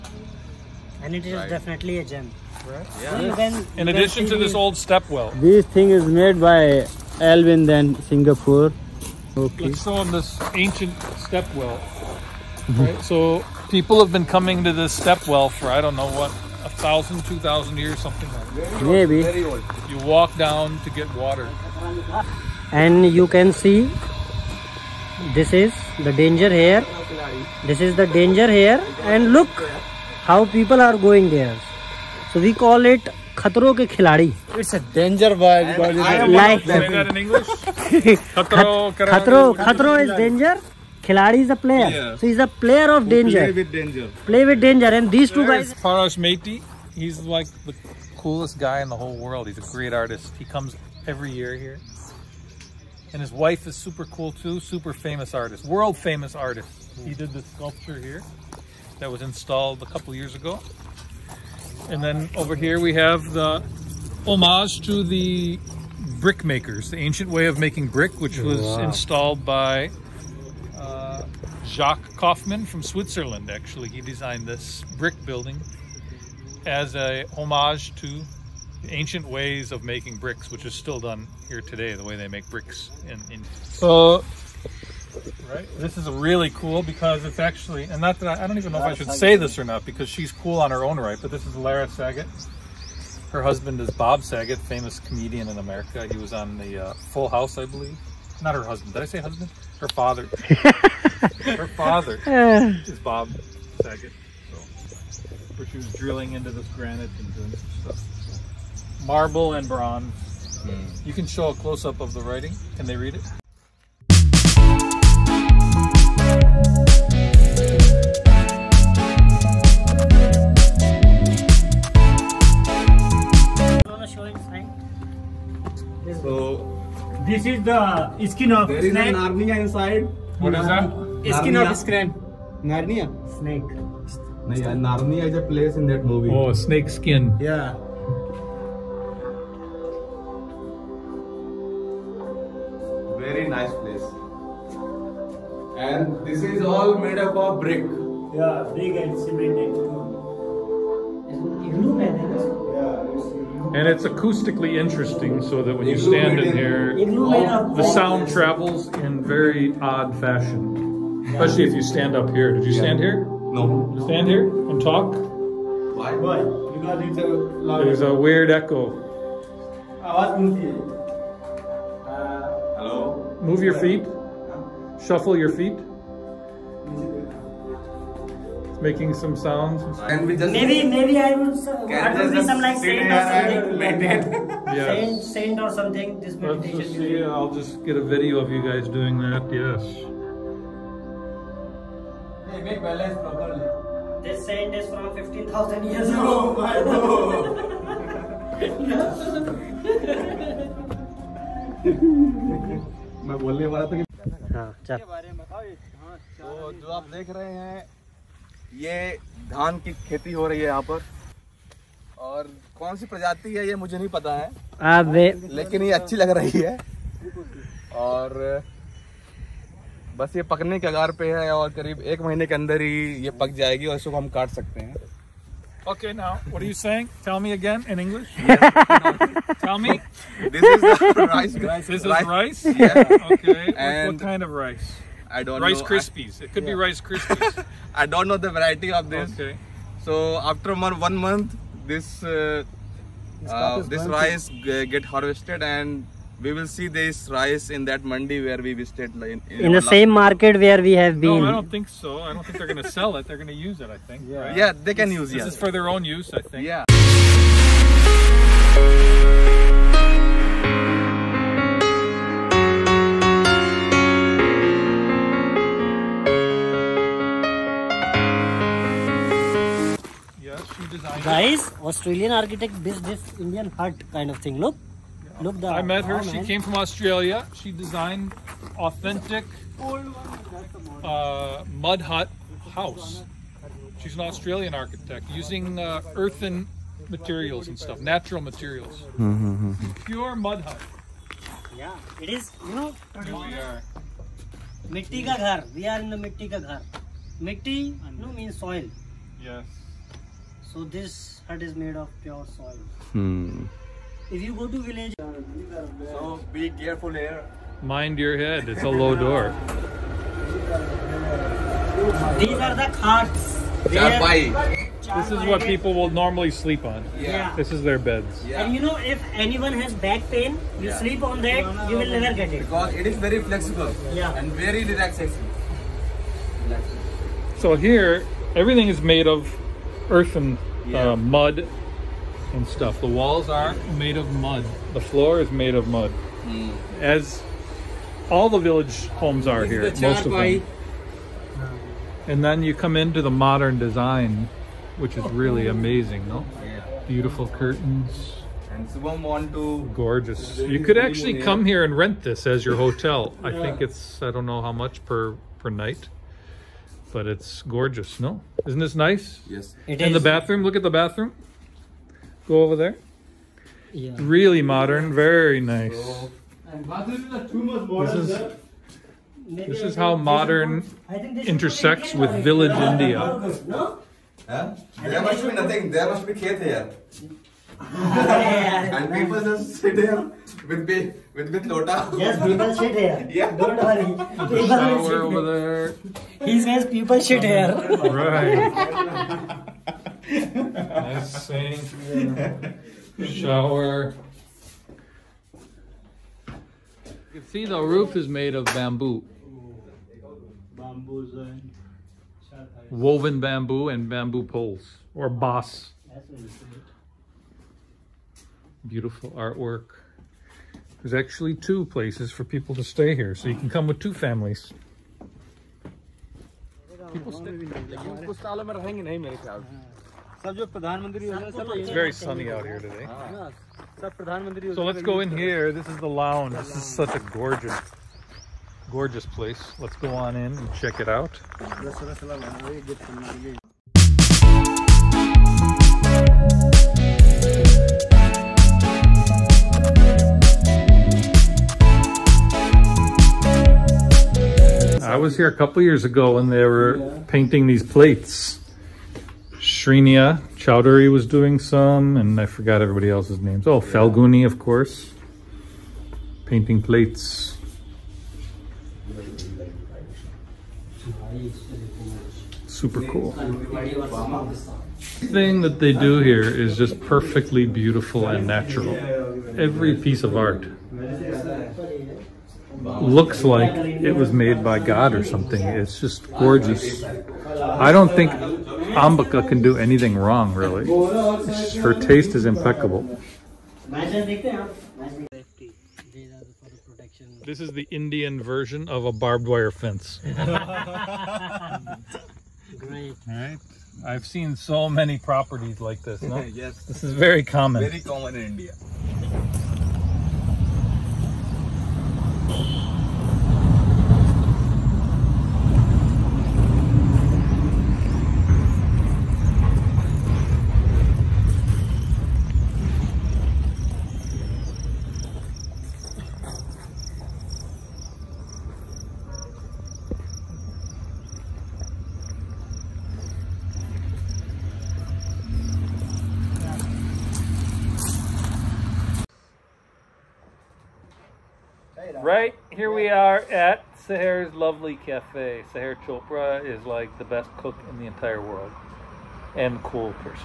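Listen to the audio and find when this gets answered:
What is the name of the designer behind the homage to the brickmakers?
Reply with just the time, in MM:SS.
01:11.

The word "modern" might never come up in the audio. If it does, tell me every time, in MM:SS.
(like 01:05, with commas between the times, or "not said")
05:43, 06:04, 06:10.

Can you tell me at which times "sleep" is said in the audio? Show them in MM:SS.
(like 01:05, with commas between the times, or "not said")
05:16, 05:20.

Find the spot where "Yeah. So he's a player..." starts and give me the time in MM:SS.
00:41.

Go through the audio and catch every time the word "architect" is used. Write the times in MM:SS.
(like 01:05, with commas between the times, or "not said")
04:32, 04:44.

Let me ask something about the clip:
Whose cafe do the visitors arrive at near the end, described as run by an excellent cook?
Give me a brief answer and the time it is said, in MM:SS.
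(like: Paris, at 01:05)
Sahar Chopra, at 08:55.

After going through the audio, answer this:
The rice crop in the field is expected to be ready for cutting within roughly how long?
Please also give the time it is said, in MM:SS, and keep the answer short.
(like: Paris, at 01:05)
1 month, at 03:42.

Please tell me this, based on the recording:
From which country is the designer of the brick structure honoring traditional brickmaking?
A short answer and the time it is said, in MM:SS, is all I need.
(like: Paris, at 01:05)
Switzerland, at 01:12.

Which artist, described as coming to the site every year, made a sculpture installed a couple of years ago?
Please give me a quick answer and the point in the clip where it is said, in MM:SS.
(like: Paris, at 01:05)
Paresh Maity, at 00:45.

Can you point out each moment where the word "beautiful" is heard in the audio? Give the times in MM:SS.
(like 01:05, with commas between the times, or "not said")
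05:47, 06:48, 07:47.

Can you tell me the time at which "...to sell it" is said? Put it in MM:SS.
04:12.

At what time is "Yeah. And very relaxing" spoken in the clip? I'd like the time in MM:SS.
05:24.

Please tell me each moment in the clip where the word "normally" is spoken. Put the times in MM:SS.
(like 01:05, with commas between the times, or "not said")
05:16.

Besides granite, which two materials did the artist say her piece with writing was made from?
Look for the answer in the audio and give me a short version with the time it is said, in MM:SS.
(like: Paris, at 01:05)
Marble and bronze, at 01:49.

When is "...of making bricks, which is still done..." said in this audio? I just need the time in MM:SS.
01:19.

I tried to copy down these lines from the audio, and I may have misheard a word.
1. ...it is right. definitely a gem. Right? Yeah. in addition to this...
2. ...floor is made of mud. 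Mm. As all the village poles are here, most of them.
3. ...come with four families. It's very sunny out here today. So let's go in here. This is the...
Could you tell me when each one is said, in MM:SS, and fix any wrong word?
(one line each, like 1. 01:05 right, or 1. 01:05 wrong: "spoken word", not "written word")
1. 00:01 right
2. 05:34 wrong: "homes", not "poles"
3. 06:53 wrong: "two", not "four".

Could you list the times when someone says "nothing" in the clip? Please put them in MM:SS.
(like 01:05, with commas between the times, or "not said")
06:15.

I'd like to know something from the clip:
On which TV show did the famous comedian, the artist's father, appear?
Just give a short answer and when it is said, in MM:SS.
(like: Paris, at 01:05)
Full House, at 01:36.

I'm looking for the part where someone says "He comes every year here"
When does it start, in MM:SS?
00:50.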